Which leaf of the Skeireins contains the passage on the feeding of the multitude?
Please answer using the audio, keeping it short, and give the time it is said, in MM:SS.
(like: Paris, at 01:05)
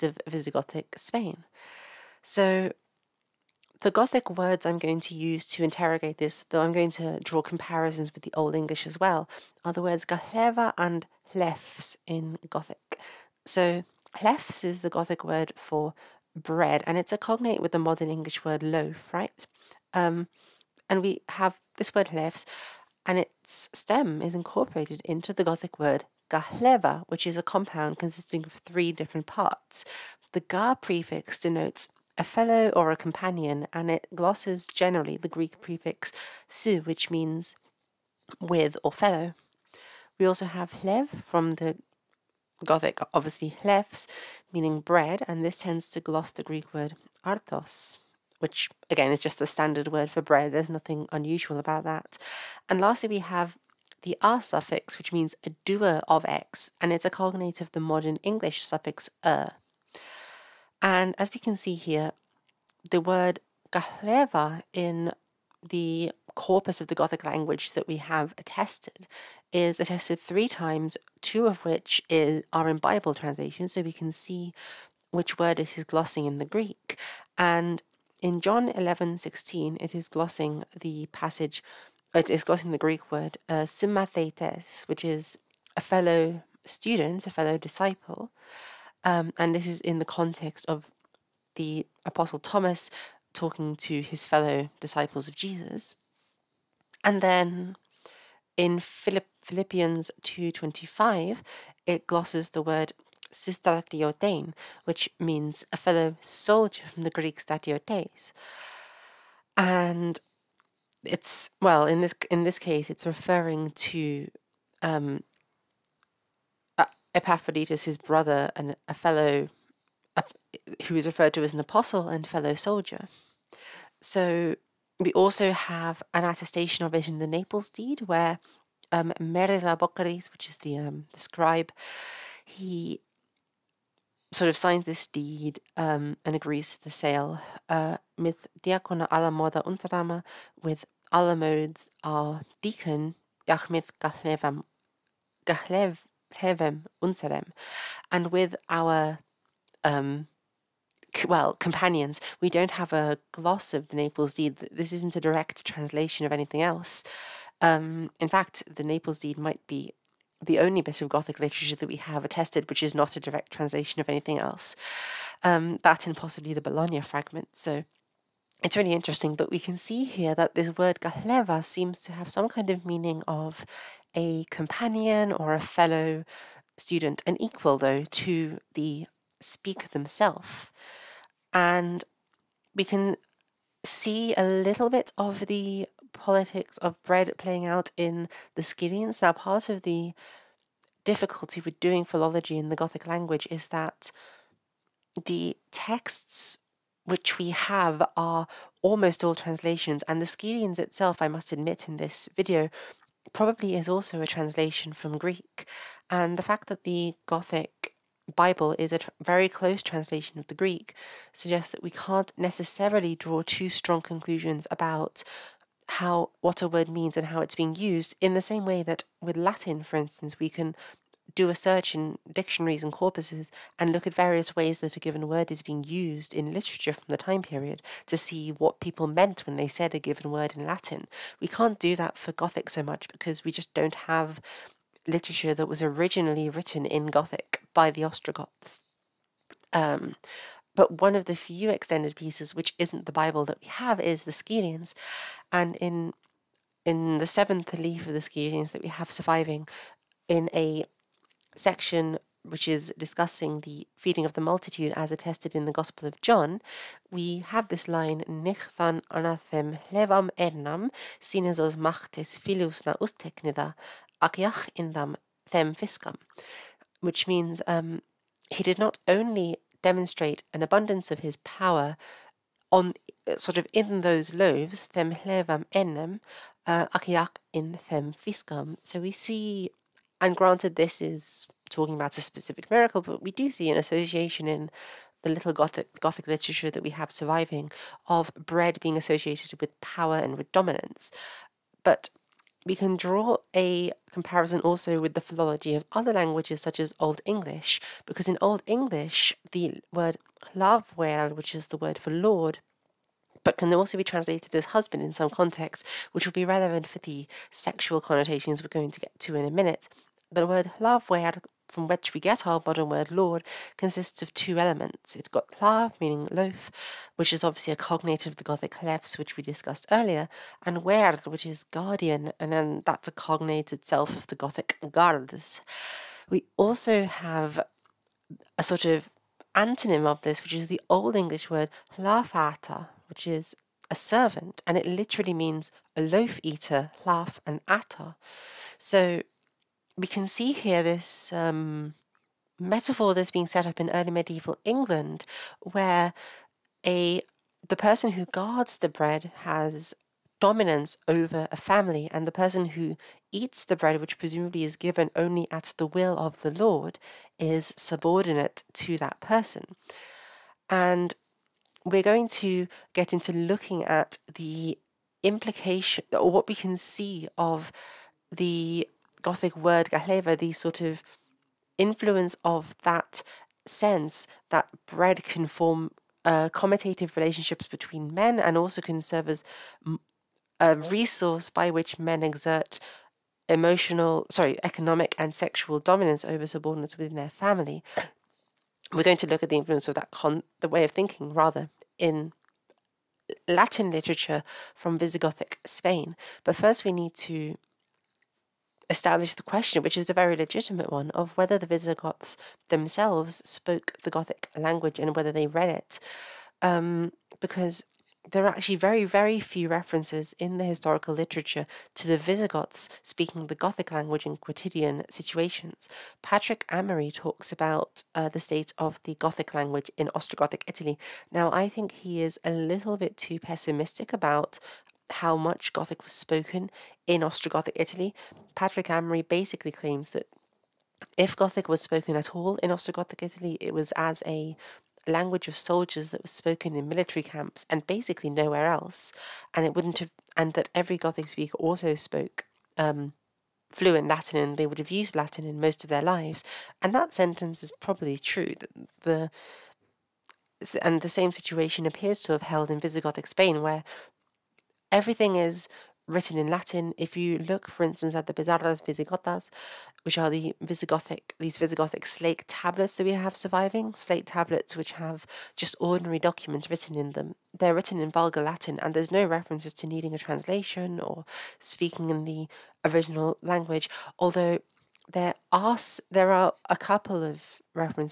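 seventh, at 04:07.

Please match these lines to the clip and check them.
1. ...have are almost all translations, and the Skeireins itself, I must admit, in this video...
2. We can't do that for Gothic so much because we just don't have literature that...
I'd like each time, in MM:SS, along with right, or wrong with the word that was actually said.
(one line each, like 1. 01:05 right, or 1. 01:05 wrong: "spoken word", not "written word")
1. 03:17 right
2. 03:51 right.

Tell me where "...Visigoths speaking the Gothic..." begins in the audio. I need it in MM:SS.
06:52.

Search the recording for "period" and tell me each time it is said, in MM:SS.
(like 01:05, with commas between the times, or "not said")
03:47.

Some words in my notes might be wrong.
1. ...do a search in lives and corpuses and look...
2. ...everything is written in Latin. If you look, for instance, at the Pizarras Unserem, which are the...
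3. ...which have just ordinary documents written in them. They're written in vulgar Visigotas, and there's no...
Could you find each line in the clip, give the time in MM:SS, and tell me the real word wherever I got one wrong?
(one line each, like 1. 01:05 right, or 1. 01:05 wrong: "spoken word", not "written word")
1. 03:41 wrong: "dictionaries", not "lives"
2. 07:34 wrong: "Visigotas", not "Unserem"
3. 07:44 wrong: "Latin", not "Visigotas".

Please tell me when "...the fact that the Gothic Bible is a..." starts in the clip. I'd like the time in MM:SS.
03:26.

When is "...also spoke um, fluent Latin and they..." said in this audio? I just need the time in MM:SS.
07:21.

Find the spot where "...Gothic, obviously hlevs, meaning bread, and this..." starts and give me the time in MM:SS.
00:42.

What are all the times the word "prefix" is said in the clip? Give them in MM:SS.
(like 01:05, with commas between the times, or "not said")
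00:30, 00:35.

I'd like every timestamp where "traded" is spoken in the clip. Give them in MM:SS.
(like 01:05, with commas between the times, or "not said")
not said.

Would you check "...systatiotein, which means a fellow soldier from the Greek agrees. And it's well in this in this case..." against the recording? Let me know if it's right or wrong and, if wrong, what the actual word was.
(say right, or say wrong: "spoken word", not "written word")
wrong: "statiotes", not "agrees".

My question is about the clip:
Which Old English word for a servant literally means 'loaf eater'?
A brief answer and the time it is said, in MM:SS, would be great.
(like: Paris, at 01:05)
hlafata, at 05:31.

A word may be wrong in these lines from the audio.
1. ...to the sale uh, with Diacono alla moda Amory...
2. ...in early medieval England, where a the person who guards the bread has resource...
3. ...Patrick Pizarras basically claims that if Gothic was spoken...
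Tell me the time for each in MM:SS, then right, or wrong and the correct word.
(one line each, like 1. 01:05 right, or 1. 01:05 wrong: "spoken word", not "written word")
1. 02:16 wrong: "Unterdama", not "Amory"
2. 05:43 wrong: "dominance", not "resource"
3. 07:08 wrong: "Amory", not "Pizarras".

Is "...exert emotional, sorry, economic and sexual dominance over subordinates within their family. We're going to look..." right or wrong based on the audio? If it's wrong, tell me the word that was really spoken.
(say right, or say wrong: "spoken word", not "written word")
right.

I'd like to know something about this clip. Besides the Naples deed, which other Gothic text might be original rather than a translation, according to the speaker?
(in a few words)
Bologna fragment.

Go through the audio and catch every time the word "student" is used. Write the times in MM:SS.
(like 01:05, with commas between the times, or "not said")
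01:26, 02:56.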